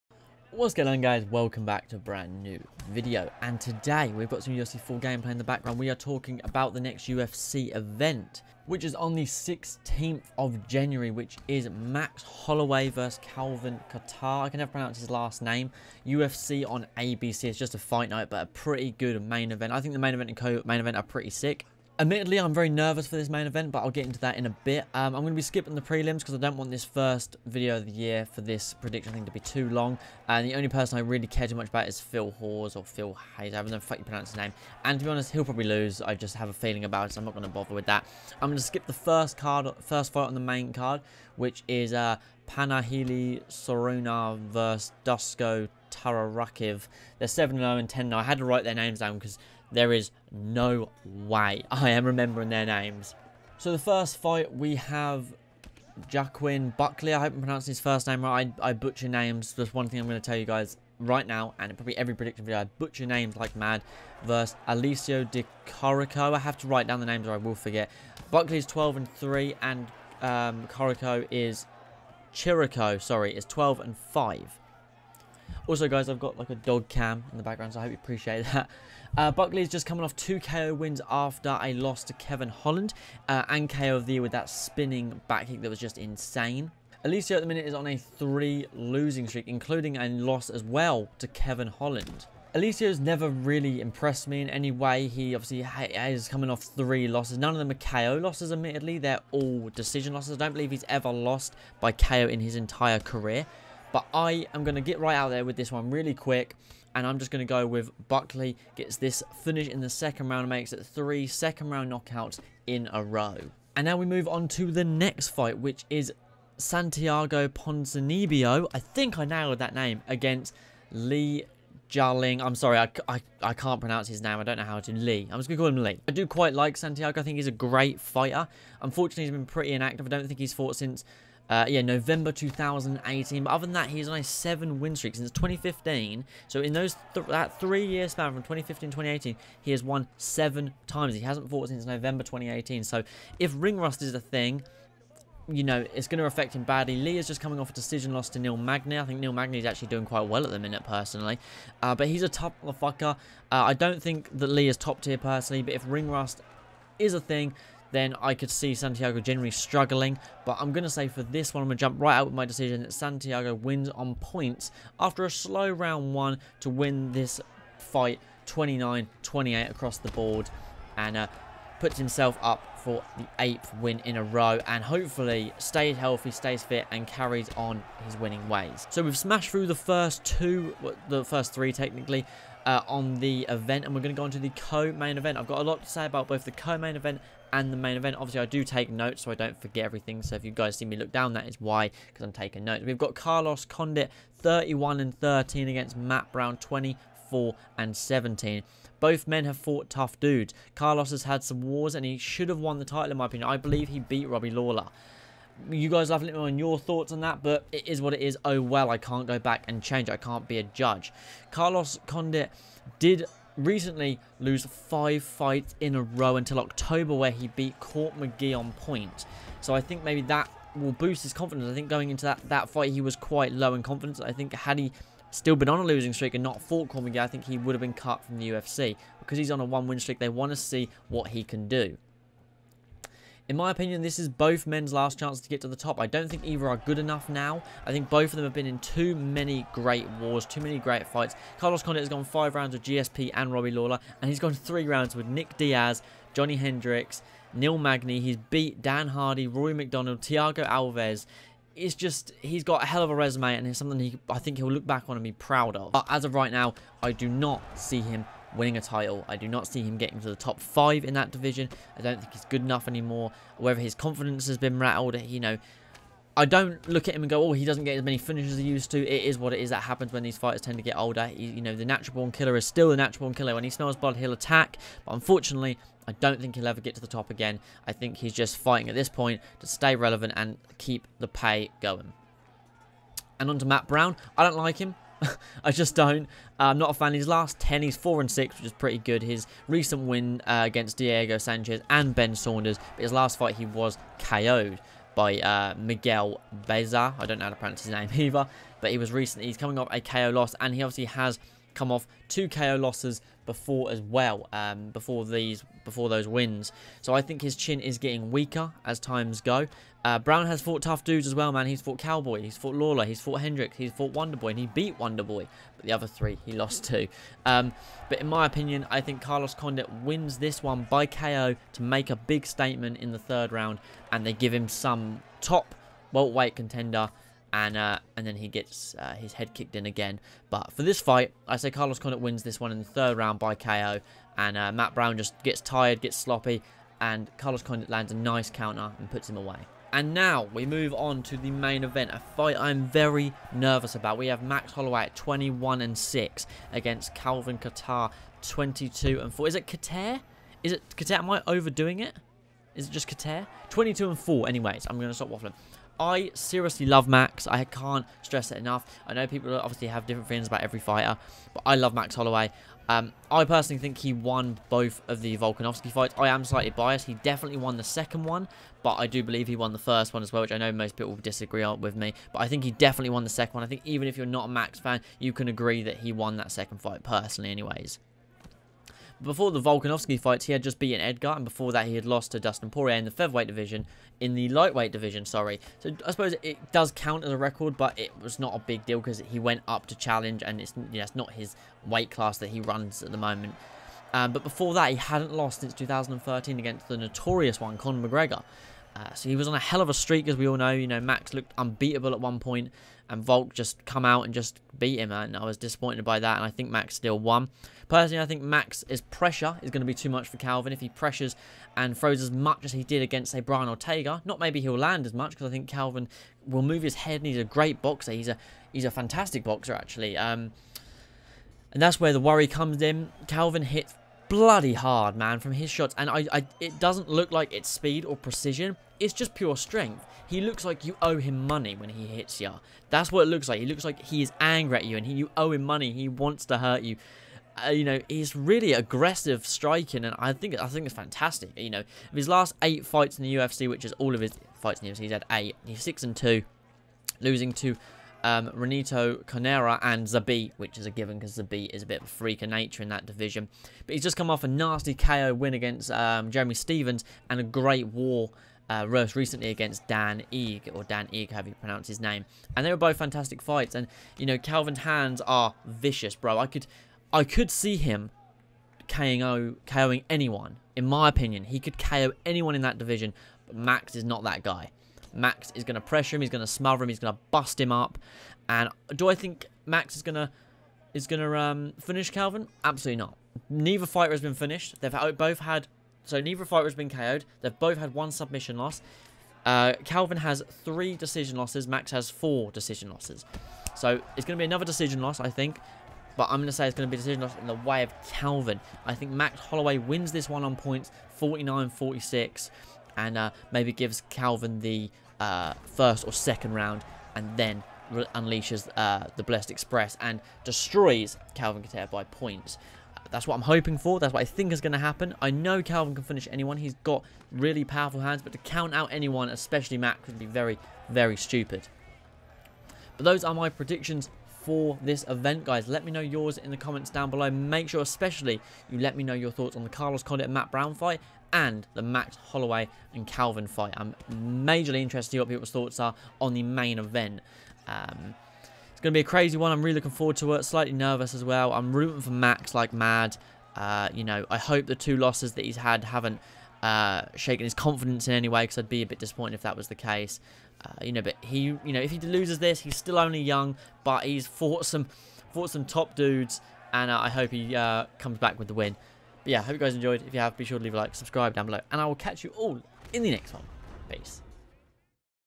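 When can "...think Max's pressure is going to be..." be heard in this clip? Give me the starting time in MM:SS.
06:48.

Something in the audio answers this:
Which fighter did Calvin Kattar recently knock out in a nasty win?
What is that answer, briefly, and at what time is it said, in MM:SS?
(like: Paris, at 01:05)
Jeremy Stephens, at 07:36.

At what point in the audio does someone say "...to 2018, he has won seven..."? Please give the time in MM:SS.
02:18.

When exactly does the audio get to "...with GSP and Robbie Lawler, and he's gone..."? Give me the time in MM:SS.
04:02.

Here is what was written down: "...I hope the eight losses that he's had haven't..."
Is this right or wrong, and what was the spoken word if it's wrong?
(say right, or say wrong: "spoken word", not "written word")
wrong: "two", not "eight".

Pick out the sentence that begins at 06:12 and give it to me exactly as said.
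But I think he definitely won the second one.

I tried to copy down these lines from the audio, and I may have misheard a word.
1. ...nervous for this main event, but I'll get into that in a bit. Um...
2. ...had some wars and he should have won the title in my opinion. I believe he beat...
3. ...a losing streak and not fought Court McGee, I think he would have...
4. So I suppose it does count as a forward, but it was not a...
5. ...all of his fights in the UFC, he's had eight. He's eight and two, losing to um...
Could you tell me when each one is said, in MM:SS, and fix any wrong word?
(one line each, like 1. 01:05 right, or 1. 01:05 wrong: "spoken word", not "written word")
1. 00:22 right
2. 03:21 right
3. 03:45 right
4. 06:25 wrong: "record", not "forward"
5. 07:23 wrong: "six", not "eight".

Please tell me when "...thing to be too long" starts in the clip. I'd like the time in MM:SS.
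00:29.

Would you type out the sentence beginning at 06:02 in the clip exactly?
Um, I personally think he won both of the Volkanovski fights.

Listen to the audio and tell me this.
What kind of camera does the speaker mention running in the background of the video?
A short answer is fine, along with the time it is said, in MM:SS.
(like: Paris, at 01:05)
dog cam, at 01:16.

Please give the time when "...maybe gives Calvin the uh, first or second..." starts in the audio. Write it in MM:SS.
08:23.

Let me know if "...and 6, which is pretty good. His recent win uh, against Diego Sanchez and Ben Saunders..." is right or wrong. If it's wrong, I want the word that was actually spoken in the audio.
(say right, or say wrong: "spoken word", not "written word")
right.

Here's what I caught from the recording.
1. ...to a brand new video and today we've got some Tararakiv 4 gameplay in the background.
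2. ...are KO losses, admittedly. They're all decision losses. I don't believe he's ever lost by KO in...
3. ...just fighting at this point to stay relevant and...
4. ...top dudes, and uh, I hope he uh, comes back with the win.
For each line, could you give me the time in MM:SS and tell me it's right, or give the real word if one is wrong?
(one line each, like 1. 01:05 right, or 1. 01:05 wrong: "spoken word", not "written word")
1. 00:01 wrong: "UFC", not "Tararakiv"
2. 01:37 right
3. 04:38 right
4. 09:15 right.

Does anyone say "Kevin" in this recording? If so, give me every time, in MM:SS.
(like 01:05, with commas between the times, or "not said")
01:22, 01:31.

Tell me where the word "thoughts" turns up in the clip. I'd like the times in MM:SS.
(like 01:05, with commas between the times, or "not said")
03:26, 08:49, 08:55.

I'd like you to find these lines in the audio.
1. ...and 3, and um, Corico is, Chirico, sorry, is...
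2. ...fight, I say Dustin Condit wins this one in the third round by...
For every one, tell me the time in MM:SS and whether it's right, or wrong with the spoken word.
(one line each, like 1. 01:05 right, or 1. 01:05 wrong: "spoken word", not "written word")
1. 01:08 right
2. 05:31 wrong: "Carlos", not "Dustin".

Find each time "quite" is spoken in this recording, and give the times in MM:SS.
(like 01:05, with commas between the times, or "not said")
02:06, 02:30, 03:43.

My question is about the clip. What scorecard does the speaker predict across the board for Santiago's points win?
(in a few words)
29-28.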